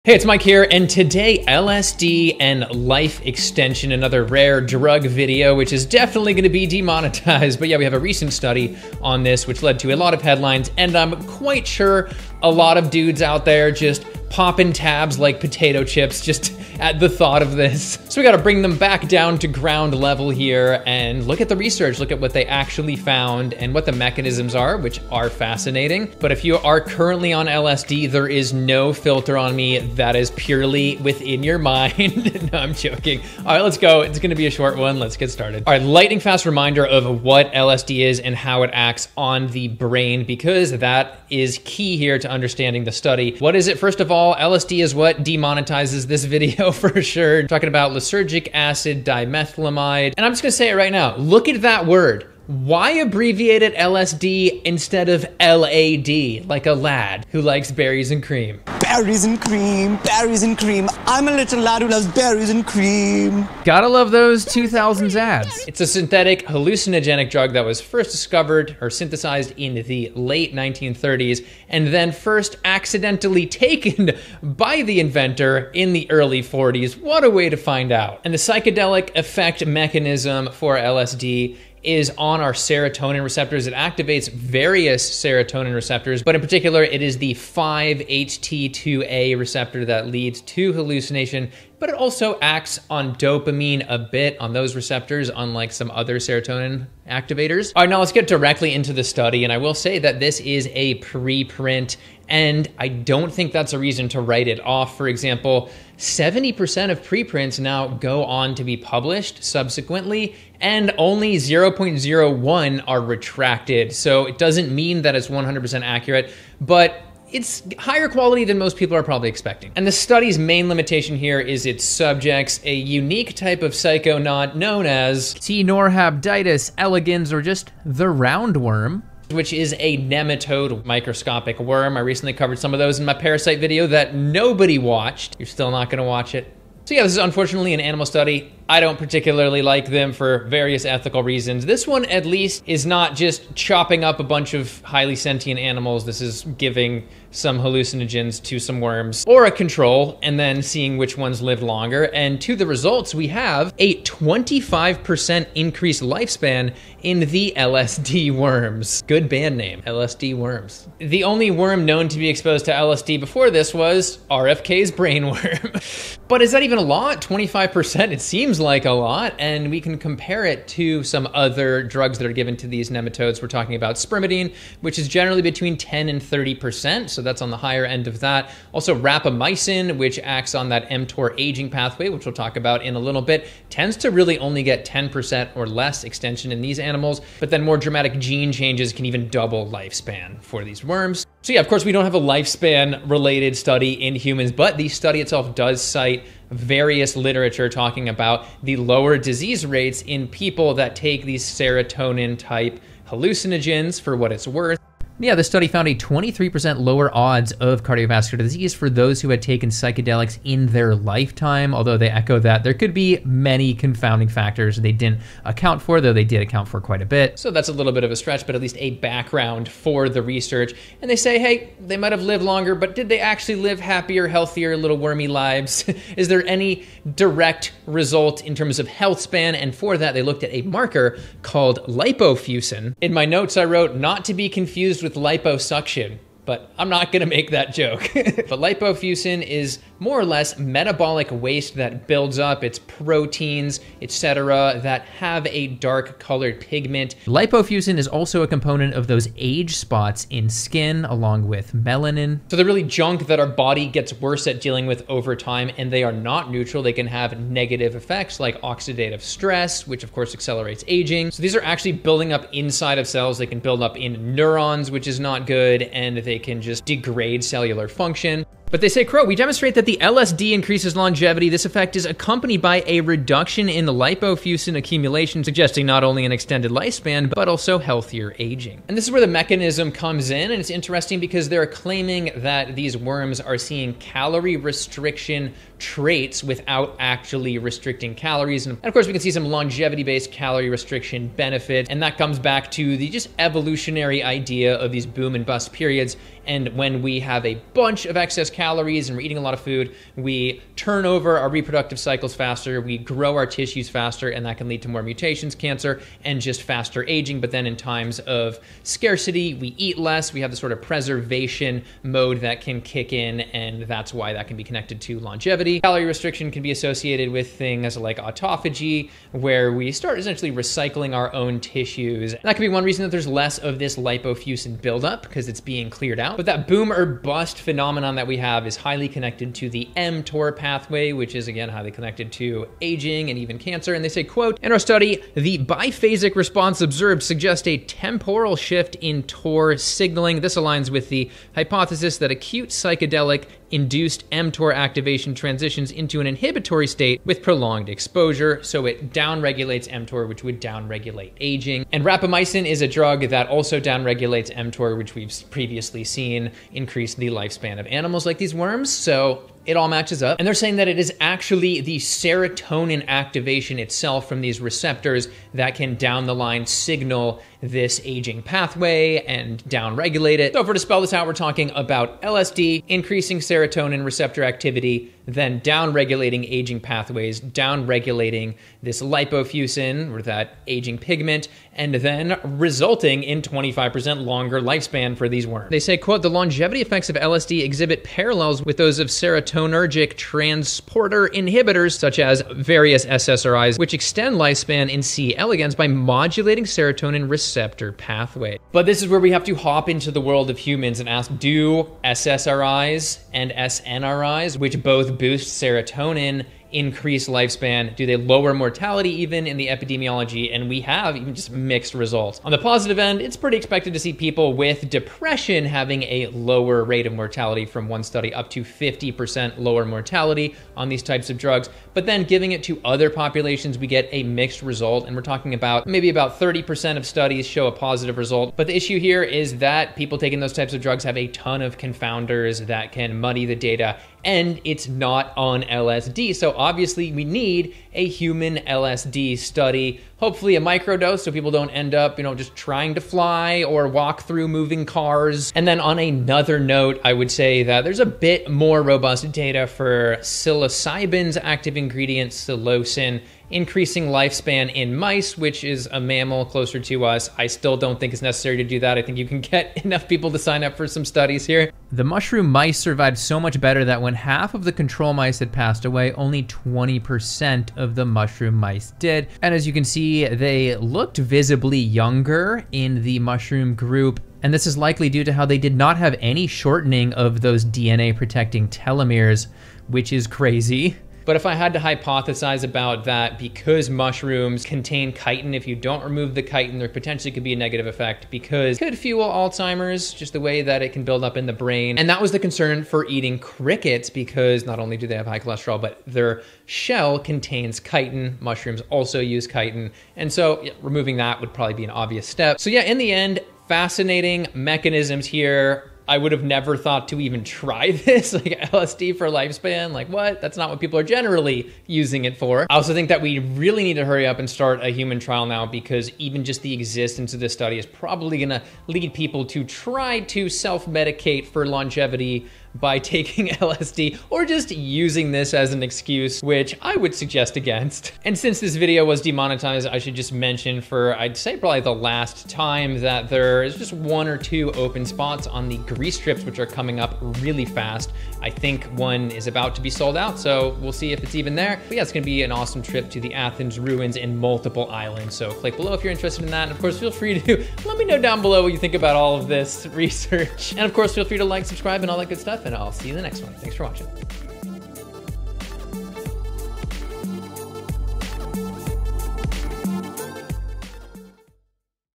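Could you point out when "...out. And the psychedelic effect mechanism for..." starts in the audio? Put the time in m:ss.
1:17.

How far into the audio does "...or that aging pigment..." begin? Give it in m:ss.
6:20.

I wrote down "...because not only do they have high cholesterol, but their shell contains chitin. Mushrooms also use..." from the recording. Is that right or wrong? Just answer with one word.
right.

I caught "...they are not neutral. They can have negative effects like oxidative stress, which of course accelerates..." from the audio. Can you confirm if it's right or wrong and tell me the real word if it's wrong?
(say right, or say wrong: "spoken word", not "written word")
right.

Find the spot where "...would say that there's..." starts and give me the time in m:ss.
7:27.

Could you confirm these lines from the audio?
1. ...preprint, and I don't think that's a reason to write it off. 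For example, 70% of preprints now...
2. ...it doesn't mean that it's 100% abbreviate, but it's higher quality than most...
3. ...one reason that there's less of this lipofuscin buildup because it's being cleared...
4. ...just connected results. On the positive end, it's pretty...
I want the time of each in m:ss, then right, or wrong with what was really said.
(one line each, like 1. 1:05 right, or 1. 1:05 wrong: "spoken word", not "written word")
1. 1:40 right
2. 1:54 wrong: "accurate", not "abbreviate"
3. 5:22 right
4. 6:51 wrong: "mixed", not "connected".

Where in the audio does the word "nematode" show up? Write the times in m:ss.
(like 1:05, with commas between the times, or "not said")
2:09, 2:52.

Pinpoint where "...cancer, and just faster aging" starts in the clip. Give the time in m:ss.
5:05.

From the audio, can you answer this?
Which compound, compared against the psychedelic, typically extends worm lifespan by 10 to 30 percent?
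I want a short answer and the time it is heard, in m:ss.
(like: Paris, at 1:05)
Spermidine, at 2:53.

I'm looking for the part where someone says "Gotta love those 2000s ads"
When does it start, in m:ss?
1:03.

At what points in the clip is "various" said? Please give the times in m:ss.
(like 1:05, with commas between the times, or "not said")
1:24, 2:20, 3:16, 6:32.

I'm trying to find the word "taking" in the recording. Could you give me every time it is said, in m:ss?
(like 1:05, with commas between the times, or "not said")
7:10, 8:42.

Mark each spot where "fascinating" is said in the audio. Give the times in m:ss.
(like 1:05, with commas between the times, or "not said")
0:25, 8:23.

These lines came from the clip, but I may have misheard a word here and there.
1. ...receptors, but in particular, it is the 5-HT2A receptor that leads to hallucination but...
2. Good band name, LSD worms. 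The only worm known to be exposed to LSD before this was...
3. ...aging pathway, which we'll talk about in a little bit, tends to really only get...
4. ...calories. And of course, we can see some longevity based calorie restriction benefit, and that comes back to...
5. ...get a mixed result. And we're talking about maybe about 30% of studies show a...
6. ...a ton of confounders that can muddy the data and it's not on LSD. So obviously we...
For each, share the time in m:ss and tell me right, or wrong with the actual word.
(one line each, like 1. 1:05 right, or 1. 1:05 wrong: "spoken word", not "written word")
1. 1:25 right
2. 2:39 right
3. 3:01 right
4. 4:48 right
5. 7:03 right
6. 7:11 right.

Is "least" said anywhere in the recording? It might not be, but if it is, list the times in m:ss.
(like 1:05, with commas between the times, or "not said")
2:22, 3:38.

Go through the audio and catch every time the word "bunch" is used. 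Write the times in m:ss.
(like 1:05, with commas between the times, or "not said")
2:24, 4:57.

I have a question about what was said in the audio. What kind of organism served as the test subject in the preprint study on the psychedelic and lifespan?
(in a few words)
Roundworm.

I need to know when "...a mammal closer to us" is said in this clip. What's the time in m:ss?
7:35.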